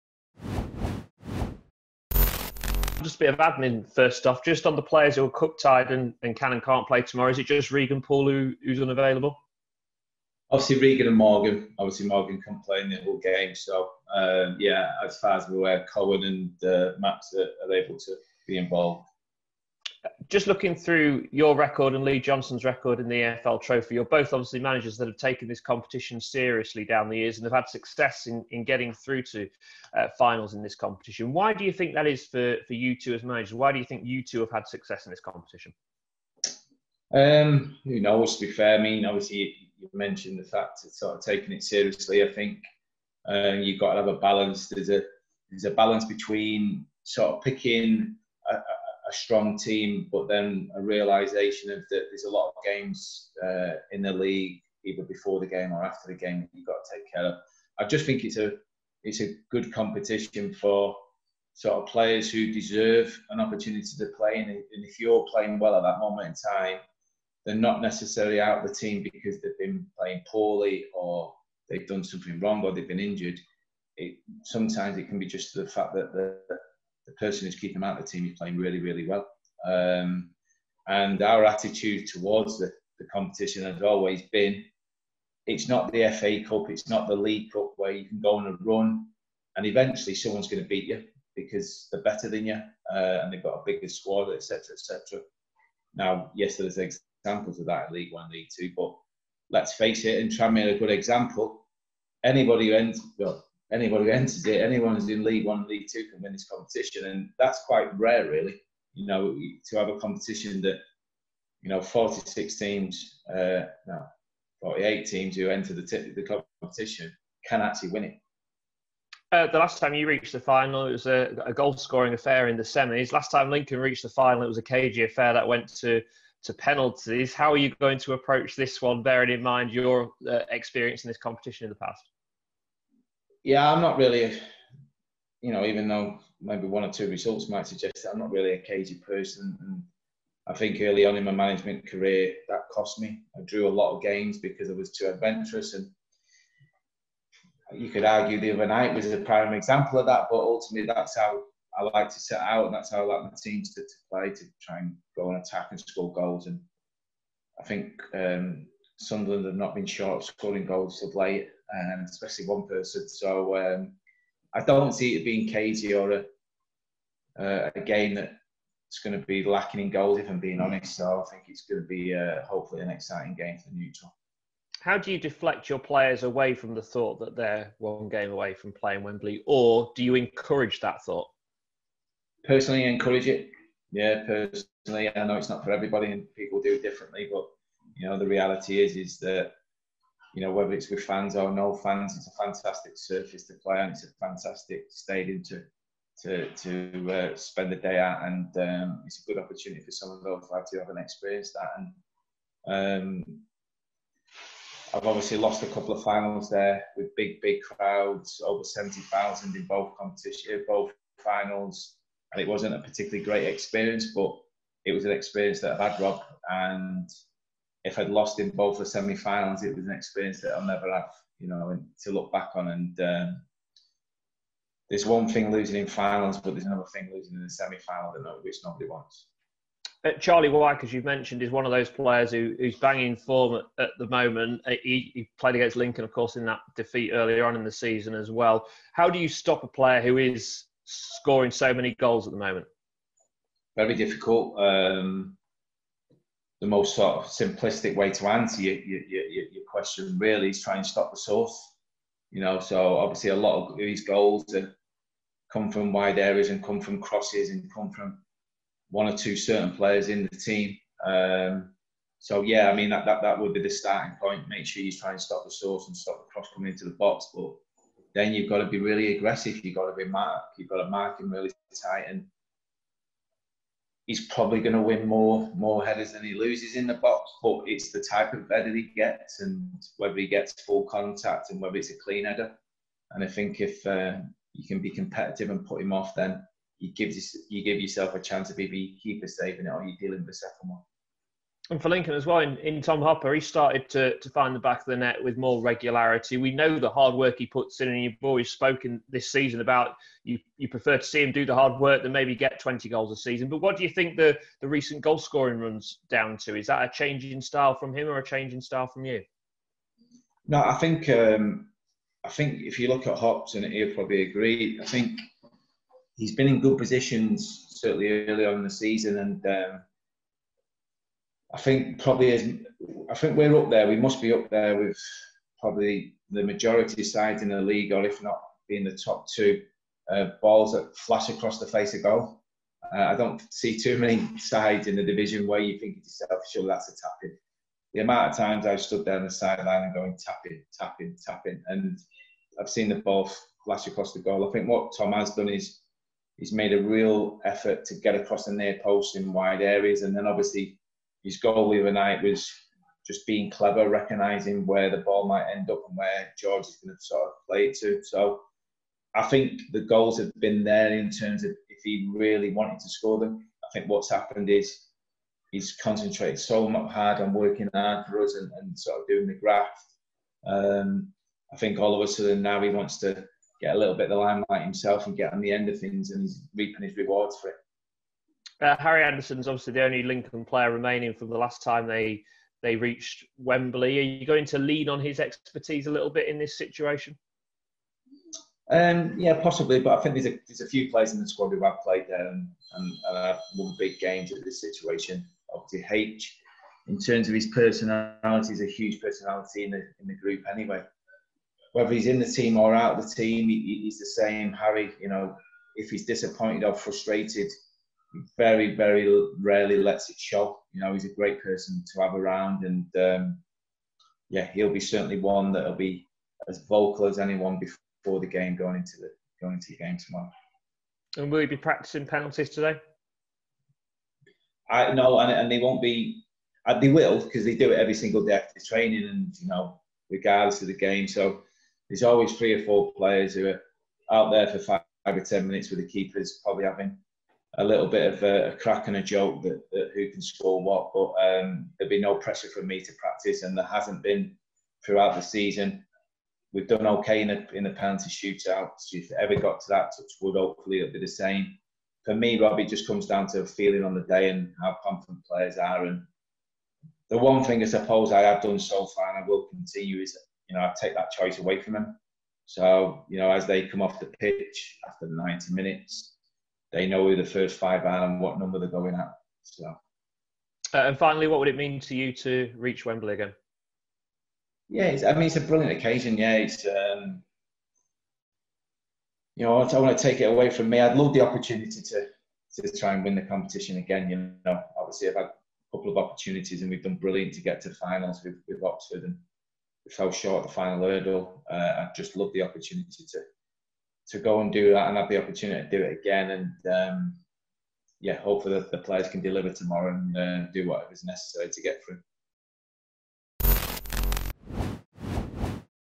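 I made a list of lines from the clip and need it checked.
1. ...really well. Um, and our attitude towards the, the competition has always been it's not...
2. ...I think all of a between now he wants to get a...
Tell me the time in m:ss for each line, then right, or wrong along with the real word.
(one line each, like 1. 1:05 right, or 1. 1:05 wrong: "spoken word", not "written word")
1. 1:18 right
2. 6:11 wrong: "sudden", not "between".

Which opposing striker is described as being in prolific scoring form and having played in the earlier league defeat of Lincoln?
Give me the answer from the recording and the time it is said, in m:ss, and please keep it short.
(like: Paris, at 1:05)
Charlie Wyke, at 3:50.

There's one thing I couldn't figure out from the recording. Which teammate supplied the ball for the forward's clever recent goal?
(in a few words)
George.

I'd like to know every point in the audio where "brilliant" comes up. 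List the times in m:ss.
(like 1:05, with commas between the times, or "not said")
7:55, 8:06.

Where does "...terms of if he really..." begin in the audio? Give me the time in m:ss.
6:01.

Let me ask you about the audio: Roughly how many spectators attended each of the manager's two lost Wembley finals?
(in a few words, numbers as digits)
over 70,000.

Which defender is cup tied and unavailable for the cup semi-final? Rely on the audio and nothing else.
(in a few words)
Regan Poole.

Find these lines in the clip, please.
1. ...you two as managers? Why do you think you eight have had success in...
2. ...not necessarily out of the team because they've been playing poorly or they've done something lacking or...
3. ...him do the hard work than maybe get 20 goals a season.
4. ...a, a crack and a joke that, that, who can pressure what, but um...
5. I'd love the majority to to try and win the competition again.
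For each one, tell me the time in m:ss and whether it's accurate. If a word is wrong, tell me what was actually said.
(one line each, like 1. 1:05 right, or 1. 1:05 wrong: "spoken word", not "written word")
1. 0:32 wrong: "two", not "eight"
2. 1:07 wrong: "wrong", not "lacking"
3. 5:01 right
4. 7:18 wrong: "score", not "pressure"
5. 8:00 wrong: "opportunity", not "majority".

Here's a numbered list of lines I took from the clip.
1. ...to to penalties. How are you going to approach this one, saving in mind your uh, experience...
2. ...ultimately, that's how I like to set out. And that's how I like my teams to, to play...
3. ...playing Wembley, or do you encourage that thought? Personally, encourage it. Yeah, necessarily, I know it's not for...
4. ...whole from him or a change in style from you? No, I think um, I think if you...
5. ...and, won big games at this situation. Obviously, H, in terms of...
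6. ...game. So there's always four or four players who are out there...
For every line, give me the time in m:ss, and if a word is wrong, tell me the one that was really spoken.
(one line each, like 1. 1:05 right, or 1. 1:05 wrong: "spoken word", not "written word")
1. 2:05 wrong: "bearing", not "saving"
2. 2:30 right
3. 2:58 wrong: "personally", not "necessarily"
4. 5:07 wrong: "style", not "whole"
5. 6:32 right
6. 7:10 wrong: "three", not "four".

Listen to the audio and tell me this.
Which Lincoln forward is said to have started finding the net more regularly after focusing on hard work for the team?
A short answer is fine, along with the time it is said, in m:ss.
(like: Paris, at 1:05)
Tom Hopper, at 4:52.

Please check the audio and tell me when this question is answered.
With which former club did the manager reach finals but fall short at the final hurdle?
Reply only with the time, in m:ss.
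8:08.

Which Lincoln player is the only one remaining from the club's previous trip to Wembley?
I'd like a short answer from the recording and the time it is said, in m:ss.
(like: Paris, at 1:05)
Harry Anderson, at 6:18.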